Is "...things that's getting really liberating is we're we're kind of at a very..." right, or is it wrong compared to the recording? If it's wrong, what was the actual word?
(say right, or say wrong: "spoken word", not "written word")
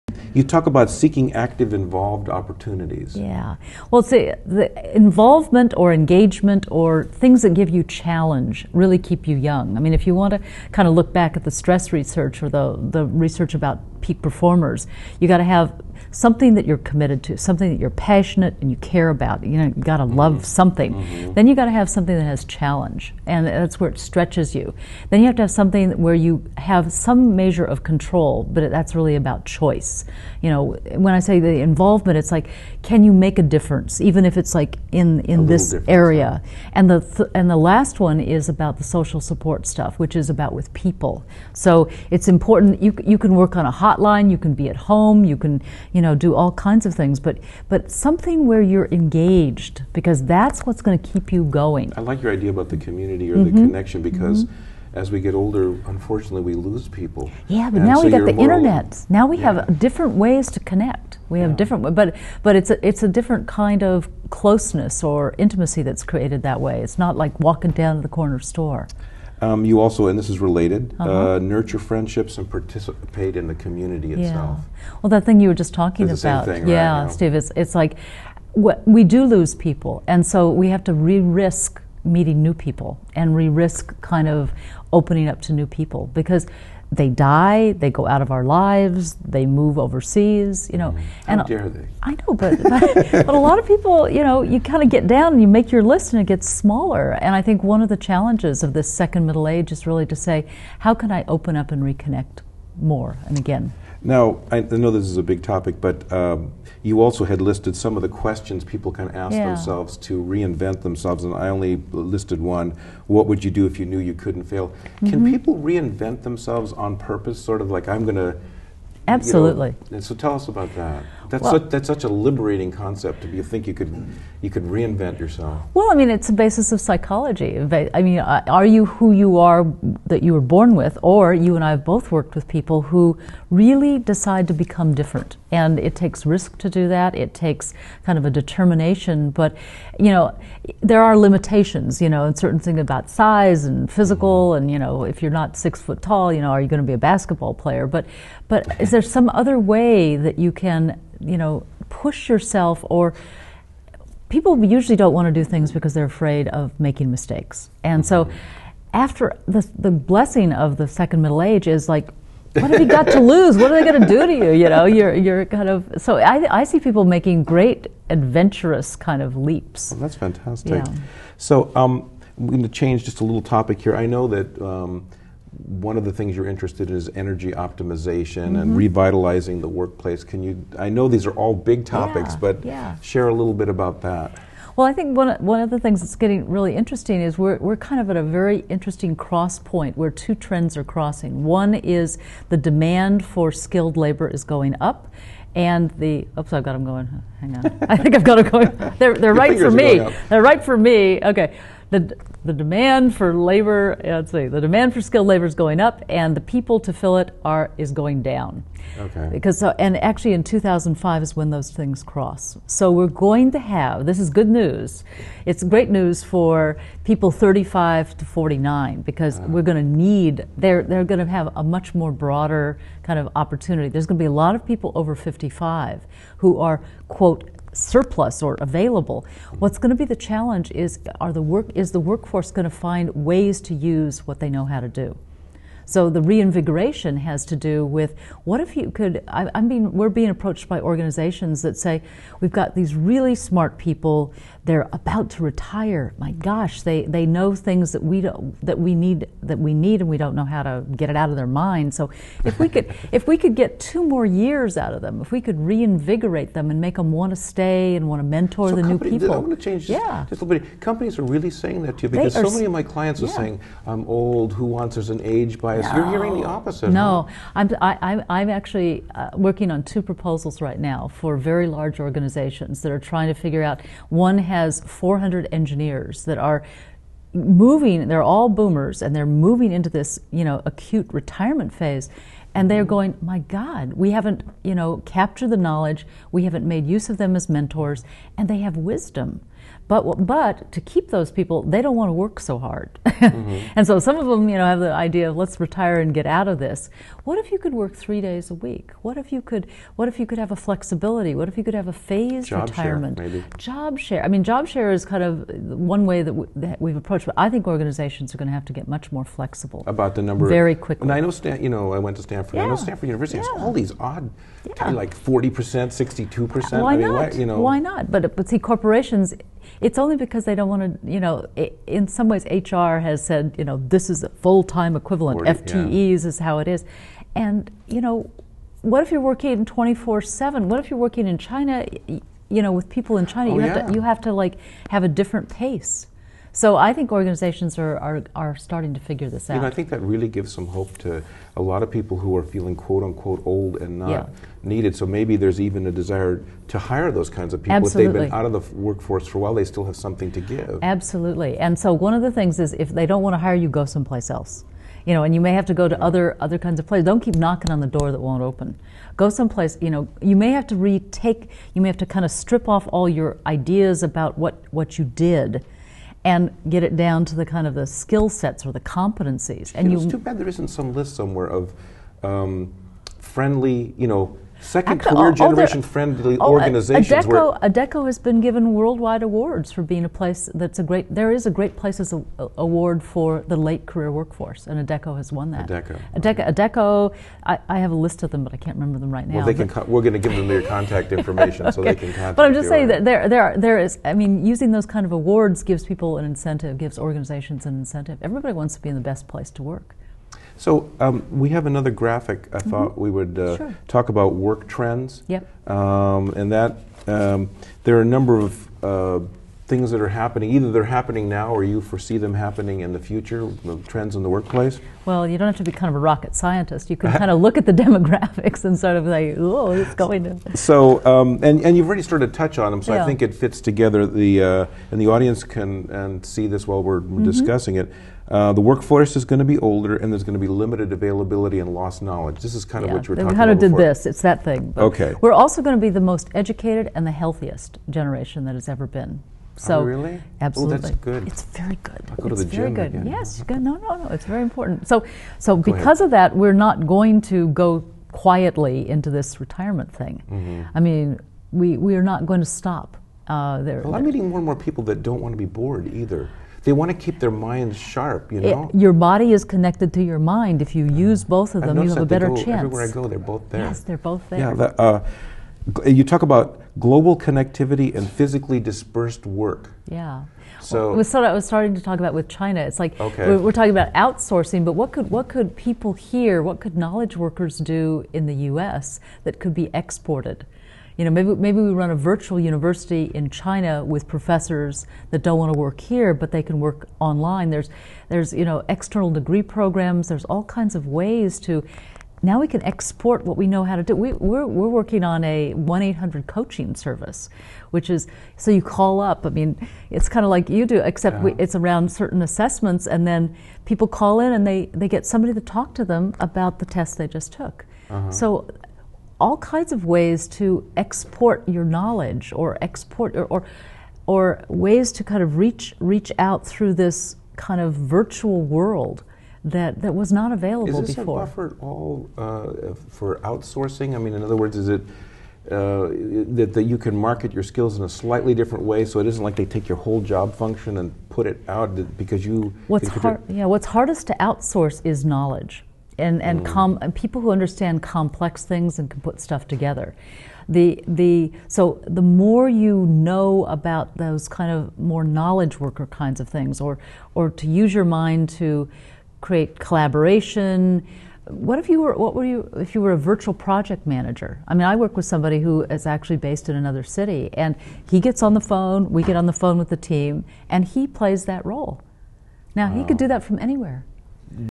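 wrong: "interesting", not "liberating".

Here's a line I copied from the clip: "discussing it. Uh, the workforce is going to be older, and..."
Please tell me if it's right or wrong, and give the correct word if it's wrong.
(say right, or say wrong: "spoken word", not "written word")
right.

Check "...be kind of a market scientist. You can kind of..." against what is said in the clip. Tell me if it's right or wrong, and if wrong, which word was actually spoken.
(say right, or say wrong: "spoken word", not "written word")
wrong: "rocket", not "market".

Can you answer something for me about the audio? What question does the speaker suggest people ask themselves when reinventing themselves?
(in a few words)
What would you do if you knew you couldn't fail?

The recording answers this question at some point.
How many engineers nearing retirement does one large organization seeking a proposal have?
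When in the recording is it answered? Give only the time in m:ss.
4:34.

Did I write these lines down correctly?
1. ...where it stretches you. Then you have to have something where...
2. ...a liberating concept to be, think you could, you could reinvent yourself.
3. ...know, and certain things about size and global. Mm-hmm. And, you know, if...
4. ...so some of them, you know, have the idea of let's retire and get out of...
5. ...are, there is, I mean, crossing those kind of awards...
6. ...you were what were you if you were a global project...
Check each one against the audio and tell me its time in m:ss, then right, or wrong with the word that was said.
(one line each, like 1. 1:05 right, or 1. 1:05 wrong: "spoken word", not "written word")
1. 0:23 right
2. 2:02 right
3. 2:22 wrong: "physical", not "global"
4. 4:53 right
5. 6:33 wrong: "using", not "crossing"
6. 9:11 wrong: "virtual", not "global".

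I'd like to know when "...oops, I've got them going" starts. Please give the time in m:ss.
3:16.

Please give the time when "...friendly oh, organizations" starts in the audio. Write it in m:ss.
6:15.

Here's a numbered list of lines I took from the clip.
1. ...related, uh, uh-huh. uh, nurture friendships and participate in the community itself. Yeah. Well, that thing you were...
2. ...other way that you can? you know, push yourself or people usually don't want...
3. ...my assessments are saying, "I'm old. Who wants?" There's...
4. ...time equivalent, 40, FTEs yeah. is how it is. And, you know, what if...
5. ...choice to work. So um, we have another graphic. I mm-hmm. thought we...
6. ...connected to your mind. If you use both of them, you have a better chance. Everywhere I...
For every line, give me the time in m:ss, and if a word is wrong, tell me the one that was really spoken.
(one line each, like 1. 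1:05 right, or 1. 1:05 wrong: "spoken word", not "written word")
1. 1:10 right
2. 2:29 right
3. 4:22 wrong: "clients", not "assessments"
4. 5:24 right
5. 6:39 wrong: "place", not "choice"
6. 7:39 right.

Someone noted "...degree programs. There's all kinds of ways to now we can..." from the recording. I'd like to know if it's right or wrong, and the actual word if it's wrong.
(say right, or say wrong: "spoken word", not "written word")
right.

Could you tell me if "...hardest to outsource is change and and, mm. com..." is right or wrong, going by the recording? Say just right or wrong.
wrong.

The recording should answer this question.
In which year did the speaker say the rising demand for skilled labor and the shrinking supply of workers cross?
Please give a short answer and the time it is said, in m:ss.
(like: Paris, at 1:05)
2005, at 3:30.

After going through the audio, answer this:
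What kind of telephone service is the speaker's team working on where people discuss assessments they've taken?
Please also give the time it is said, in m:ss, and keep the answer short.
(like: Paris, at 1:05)
1-800 coaching service, at 8:15.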